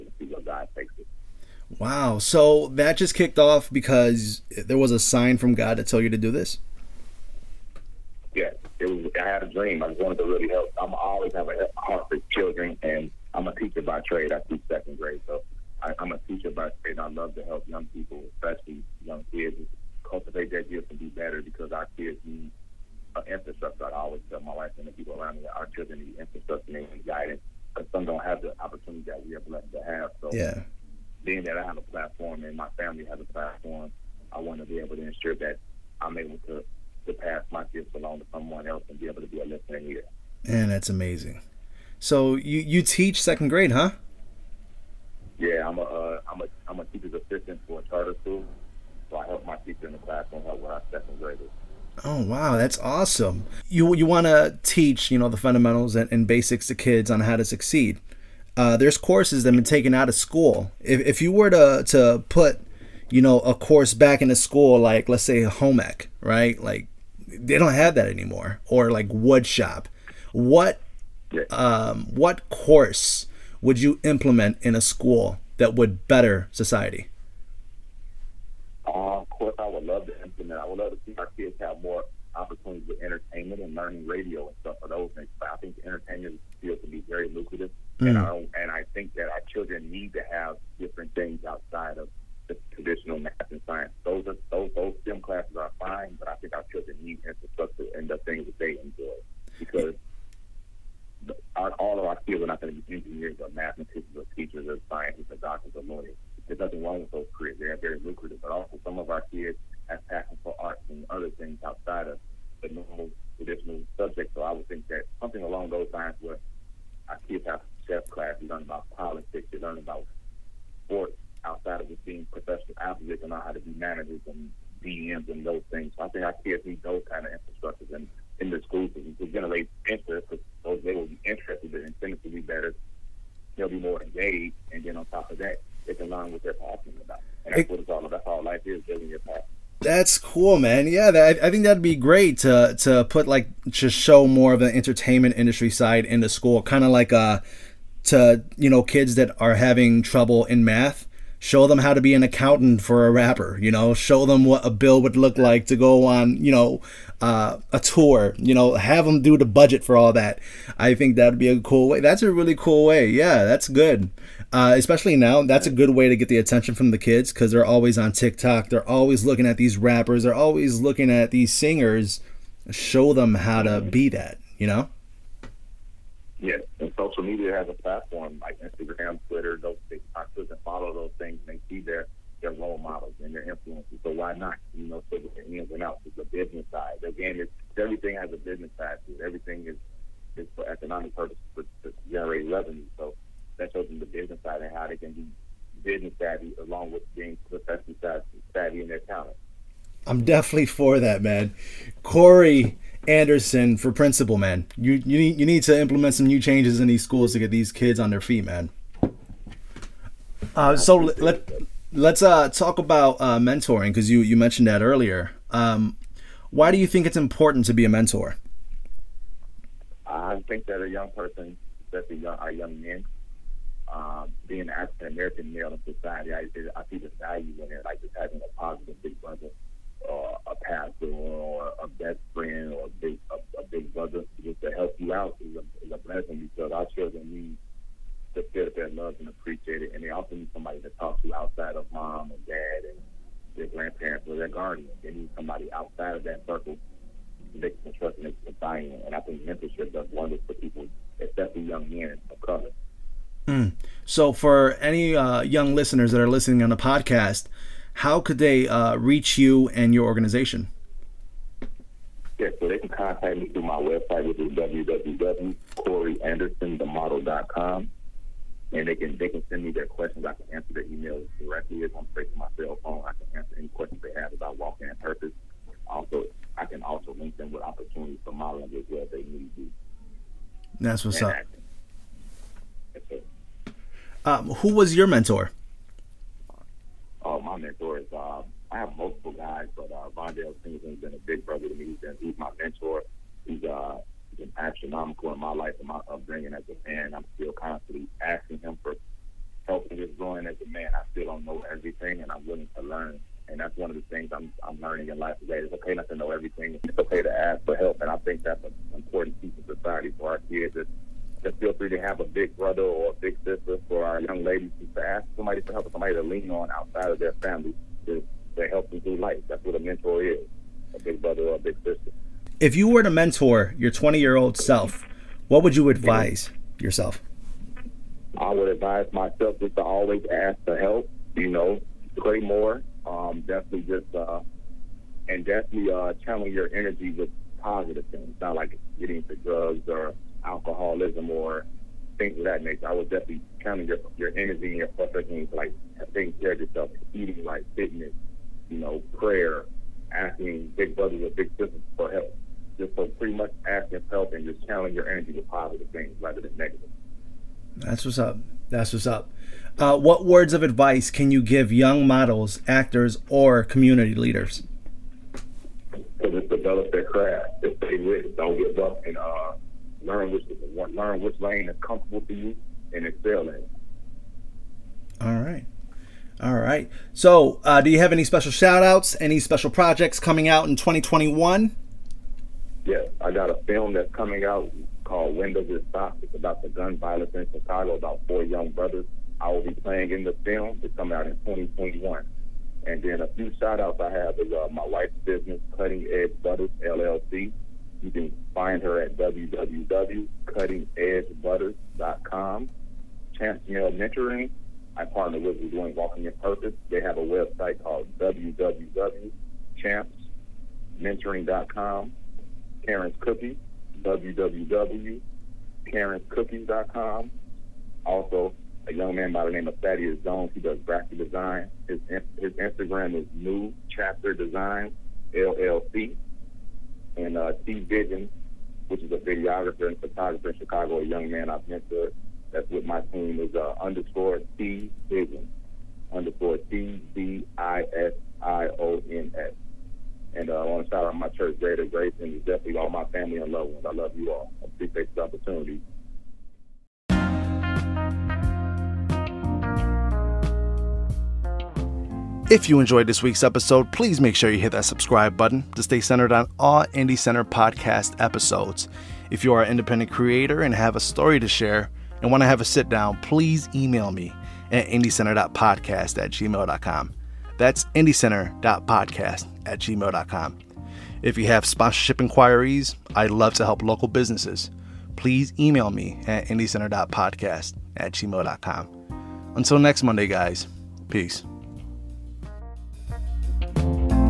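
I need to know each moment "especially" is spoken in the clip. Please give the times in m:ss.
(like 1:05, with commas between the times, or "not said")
0:18, 2:44, 3:41, 4:11.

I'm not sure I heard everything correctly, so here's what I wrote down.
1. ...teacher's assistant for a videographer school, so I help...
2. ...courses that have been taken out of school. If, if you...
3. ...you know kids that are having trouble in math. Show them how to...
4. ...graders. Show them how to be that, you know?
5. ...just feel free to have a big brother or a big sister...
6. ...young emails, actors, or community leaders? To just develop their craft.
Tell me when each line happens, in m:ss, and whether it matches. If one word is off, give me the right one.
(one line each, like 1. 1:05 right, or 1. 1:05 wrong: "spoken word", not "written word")
1. 0:46 wrong: "charter", not "videographer"
2. 0:58 right
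3. 2:28 right
4. 2:51 wrong: "singers", not "graders"
5. 5:11 right
6. 6:01 wrong: "models", not "emails".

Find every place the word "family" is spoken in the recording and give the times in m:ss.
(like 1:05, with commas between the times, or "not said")
0:32, 5:17, 7:23.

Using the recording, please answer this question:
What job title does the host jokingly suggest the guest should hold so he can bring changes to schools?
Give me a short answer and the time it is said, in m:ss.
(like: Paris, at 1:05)
Principal, at 3:23.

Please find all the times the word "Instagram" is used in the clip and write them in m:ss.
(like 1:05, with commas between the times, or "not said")
2:58, 7:02.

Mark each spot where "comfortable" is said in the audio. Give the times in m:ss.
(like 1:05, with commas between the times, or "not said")
6:11.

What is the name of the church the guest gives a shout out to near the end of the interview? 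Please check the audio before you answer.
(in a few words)
Greater Grace.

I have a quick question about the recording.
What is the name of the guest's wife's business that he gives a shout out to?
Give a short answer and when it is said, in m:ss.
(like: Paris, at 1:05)
Cutting Edge Butters LLC, at 6:35.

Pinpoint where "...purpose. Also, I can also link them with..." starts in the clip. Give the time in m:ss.
4:34.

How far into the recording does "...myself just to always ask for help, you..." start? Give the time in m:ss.
5:29.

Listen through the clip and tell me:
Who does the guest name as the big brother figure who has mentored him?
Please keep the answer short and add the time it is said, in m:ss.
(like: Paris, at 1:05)
Vondale Singleton, at 4:50.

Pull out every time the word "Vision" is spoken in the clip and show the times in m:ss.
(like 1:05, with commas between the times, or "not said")
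7:07, 7:15.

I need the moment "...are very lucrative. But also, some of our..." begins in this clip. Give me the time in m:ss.
1:47.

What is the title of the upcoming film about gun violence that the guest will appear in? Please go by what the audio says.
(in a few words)
Windows is Stopped.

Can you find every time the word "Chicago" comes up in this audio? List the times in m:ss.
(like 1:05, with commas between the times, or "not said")
6:27, 7:10.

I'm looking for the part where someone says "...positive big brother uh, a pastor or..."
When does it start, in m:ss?
3:48.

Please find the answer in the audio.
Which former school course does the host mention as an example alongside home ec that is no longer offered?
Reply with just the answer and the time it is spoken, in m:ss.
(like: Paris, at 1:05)
Wood shop, at 1:09.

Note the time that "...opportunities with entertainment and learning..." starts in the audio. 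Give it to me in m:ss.
1:22.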